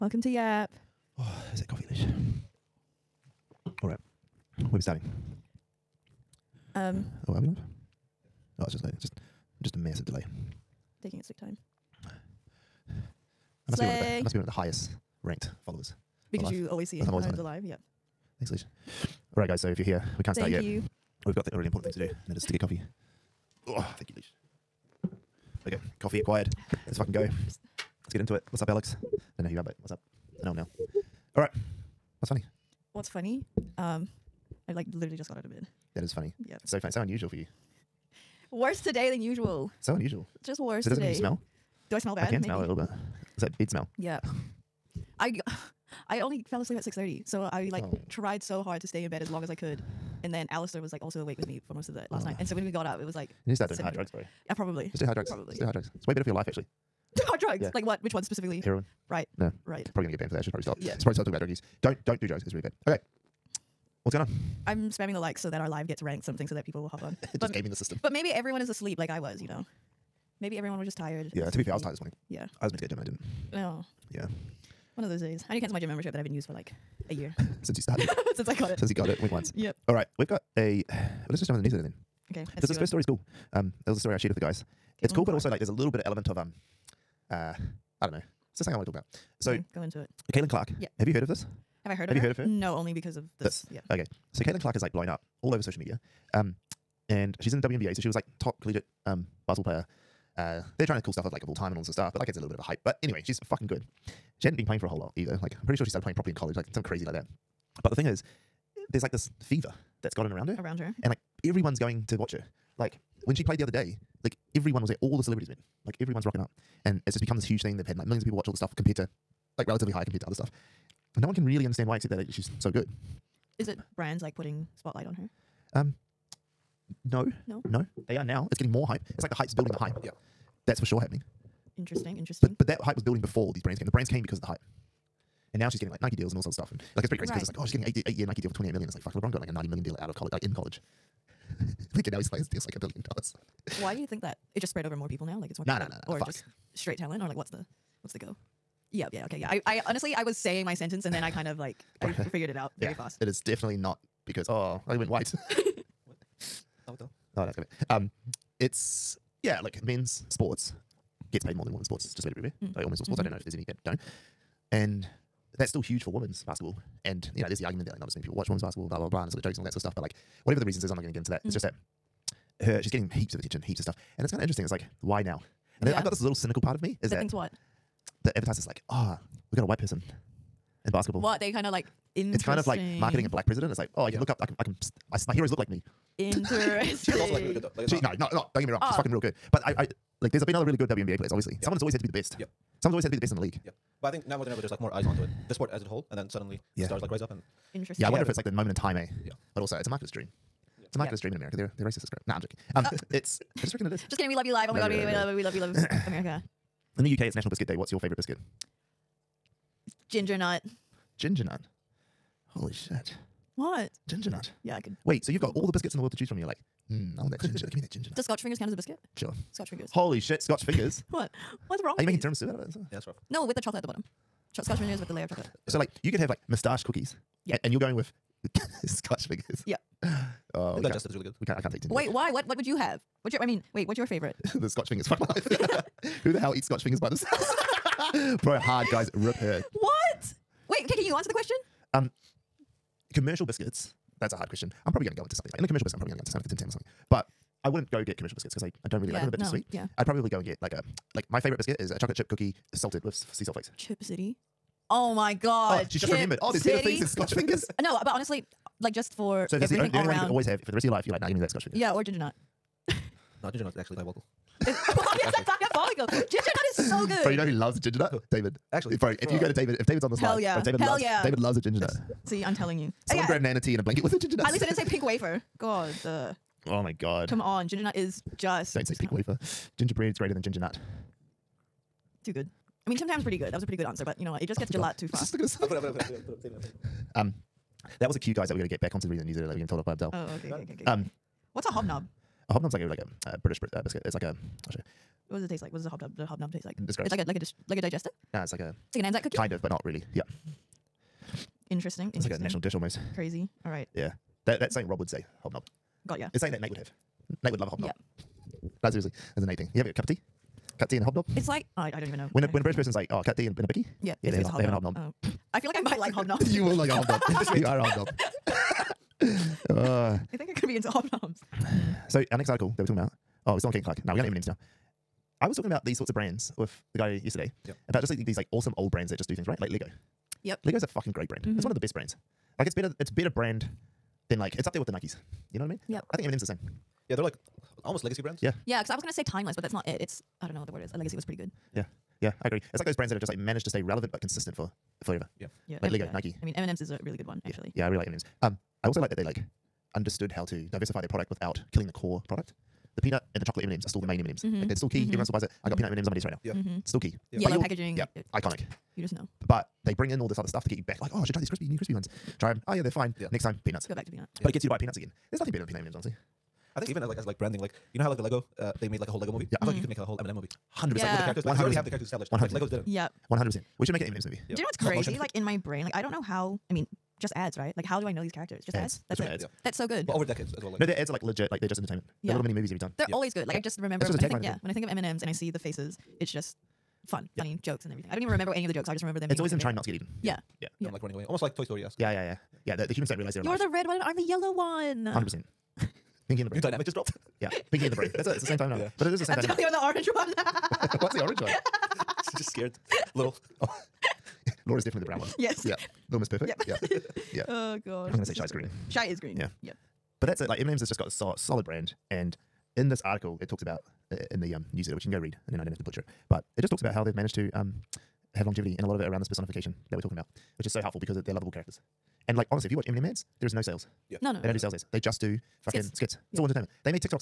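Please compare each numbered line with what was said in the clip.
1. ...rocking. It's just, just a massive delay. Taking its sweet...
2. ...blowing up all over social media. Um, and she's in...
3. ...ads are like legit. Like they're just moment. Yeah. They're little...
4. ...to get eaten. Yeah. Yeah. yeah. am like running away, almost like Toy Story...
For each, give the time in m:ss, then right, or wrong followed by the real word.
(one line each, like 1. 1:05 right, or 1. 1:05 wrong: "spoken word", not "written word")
1. 0:08 wrong: "loading", not "rocking"
2. 1:34 right
3. 6:20 wrong: "entertainment", not "moment"
4. 6:29 right.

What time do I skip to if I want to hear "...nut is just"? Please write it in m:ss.
4:37.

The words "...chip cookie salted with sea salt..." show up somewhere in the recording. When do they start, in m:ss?
4:12.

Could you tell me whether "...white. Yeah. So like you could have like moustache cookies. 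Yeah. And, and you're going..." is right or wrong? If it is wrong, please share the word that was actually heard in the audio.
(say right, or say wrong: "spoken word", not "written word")
wrong: "chocolate", not "white".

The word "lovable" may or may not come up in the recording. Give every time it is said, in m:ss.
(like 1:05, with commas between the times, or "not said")
7:01.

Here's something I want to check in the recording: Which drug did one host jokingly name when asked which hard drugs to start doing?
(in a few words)
Heroin.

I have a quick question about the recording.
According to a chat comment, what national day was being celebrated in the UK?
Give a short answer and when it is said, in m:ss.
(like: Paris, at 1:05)
National Biscuit Day, at 3:27.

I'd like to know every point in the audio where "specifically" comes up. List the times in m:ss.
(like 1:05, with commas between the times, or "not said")
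0:58.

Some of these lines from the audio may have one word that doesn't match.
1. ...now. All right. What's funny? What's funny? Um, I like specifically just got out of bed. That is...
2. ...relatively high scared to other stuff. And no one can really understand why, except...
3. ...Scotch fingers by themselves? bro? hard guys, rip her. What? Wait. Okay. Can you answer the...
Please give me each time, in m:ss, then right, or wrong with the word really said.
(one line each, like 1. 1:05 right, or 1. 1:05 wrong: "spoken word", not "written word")
1. 0:30 wrong: "literally", not "specifically"
2. 1:59 wrong: "compared", not "scared"
3. 3:56 right.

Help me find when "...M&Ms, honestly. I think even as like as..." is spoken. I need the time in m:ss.
6:05.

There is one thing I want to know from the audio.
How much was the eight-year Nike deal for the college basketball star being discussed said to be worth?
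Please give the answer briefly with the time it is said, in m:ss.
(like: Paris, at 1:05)
28 million, at 2:18.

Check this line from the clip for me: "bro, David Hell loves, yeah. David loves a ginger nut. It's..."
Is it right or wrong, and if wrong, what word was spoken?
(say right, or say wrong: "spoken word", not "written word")
right.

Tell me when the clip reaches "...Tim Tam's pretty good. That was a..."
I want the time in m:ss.
4:42.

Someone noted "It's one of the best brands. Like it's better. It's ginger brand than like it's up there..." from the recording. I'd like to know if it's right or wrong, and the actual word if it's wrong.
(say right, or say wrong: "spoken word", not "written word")
wrong: "better", not "ginger".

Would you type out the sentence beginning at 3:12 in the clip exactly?
Yeah, Someone's always had to be the best in the league.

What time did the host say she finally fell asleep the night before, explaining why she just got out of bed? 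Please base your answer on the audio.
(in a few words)
6:30.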